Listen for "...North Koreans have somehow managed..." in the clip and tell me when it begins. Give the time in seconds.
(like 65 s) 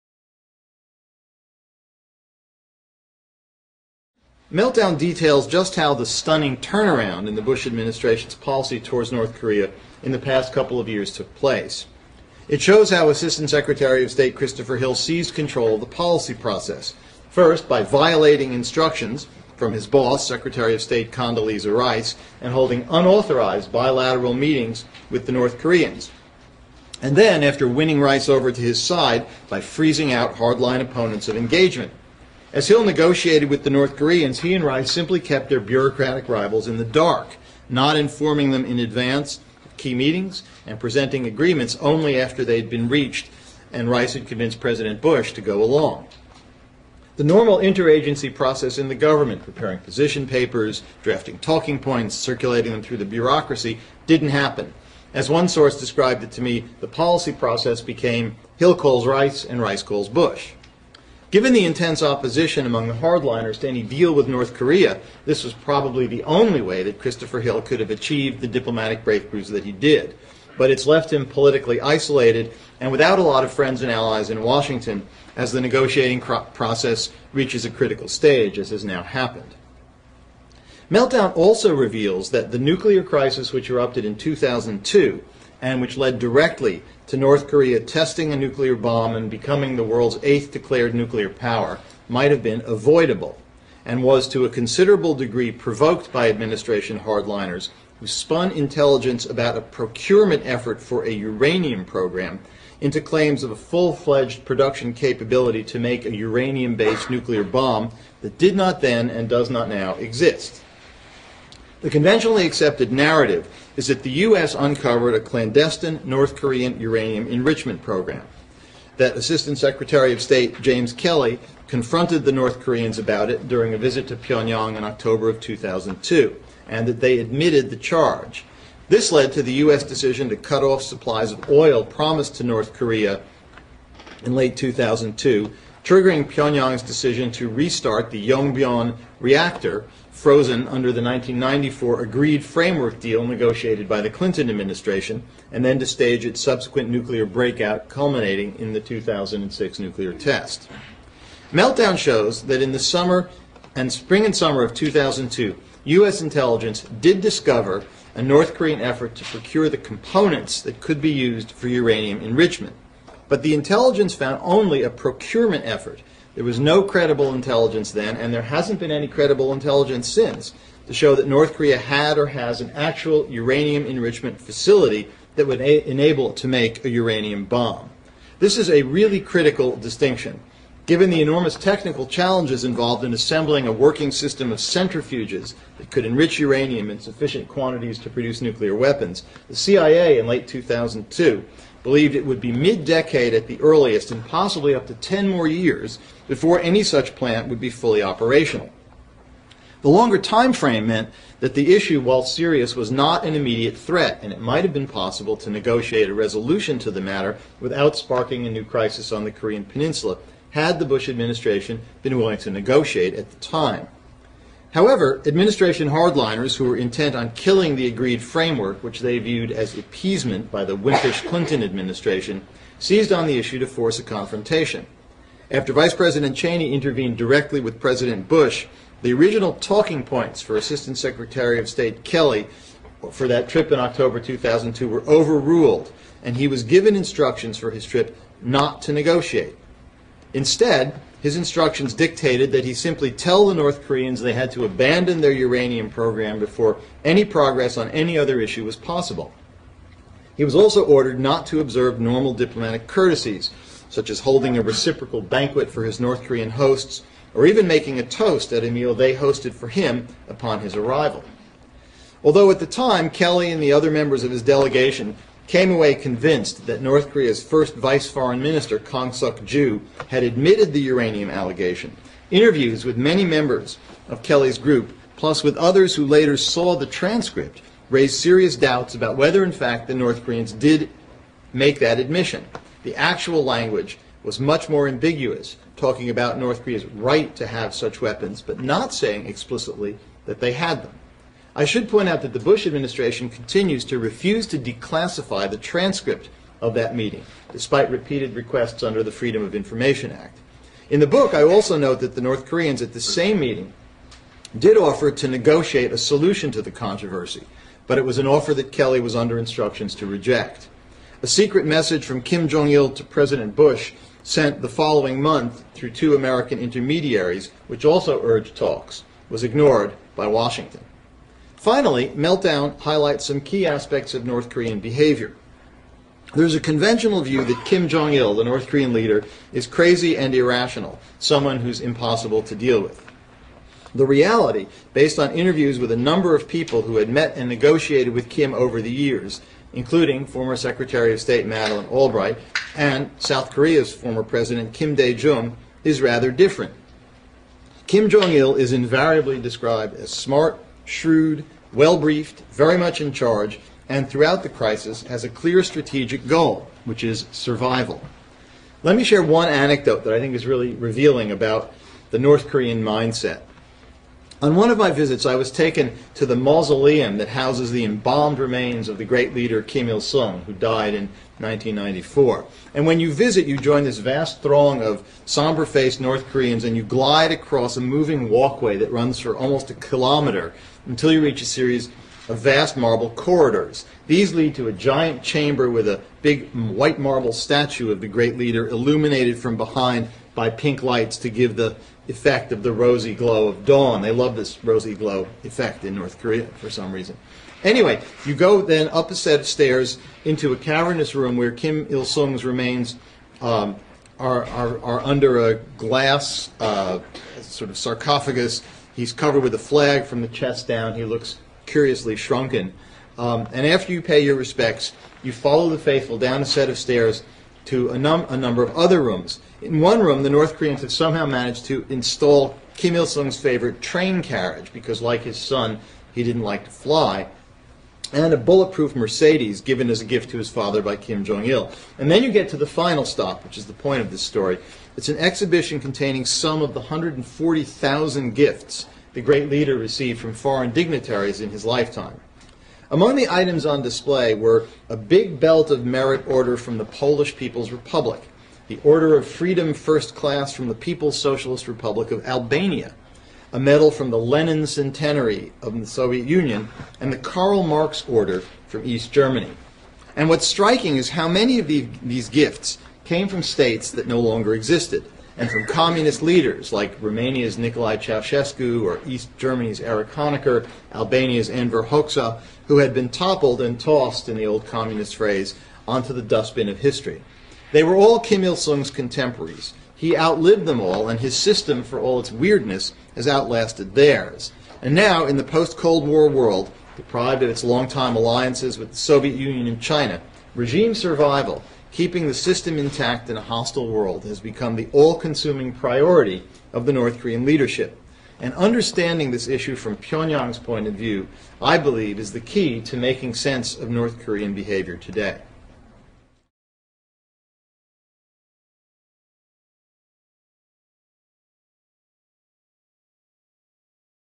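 420 s.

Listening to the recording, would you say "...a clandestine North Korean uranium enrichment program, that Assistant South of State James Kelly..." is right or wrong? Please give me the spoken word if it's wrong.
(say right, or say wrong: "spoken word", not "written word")
wrong: "Secretary", not "South".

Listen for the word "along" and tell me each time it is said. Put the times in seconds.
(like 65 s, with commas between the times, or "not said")
45 s.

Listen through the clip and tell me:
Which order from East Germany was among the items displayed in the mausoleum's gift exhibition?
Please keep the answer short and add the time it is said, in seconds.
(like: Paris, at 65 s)
Karl Marx Order, at 457 s.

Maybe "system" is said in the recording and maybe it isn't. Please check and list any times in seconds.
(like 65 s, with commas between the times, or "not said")
184 s, 481 s, 492 s.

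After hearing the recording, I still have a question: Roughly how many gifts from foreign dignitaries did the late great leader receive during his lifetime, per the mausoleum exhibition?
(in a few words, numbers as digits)
140,000.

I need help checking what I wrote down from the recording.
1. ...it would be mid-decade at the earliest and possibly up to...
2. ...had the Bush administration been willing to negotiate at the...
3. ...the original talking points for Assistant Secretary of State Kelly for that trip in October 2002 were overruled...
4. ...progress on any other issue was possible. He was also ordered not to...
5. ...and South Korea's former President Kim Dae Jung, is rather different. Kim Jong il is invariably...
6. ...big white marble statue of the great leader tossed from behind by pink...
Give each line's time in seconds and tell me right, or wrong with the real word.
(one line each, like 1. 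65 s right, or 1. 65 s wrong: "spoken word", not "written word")
1. 192 s right
2. 210 s right
3. 229 s right
4. 247 s right
5. 342 s right
6. 386 s wrong: "illuminated", not "tossed".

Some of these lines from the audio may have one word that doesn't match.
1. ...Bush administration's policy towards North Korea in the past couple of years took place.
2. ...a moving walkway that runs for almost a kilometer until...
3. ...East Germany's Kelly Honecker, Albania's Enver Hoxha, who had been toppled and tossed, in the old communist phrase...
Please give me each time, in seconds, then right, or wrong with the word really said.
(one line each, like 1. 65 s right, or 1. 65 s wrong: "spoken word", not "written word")
1. 7 s right
2. 377 s right
3. 469 s wrong: "Erich", not "Kelly".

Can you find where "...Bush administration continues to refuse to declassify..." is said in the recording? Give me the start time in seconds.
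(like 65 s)
292 s.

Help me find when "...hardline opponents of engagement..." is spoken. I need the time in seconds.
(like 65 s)
30 s.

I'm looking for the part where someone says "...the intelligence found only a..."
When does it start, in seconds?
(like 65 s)
163 s.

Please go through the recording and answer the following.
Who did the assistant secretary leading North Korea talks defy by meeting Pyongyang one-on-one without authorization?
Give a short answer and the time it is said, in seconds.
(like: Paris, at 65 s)
Condoleezza Rice, at 21 s.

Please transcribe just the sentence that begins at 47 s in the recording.
The normal interagency process in the government, preparing position papers, drafting talking points, circulating them through the bureaucracy, didn't happen.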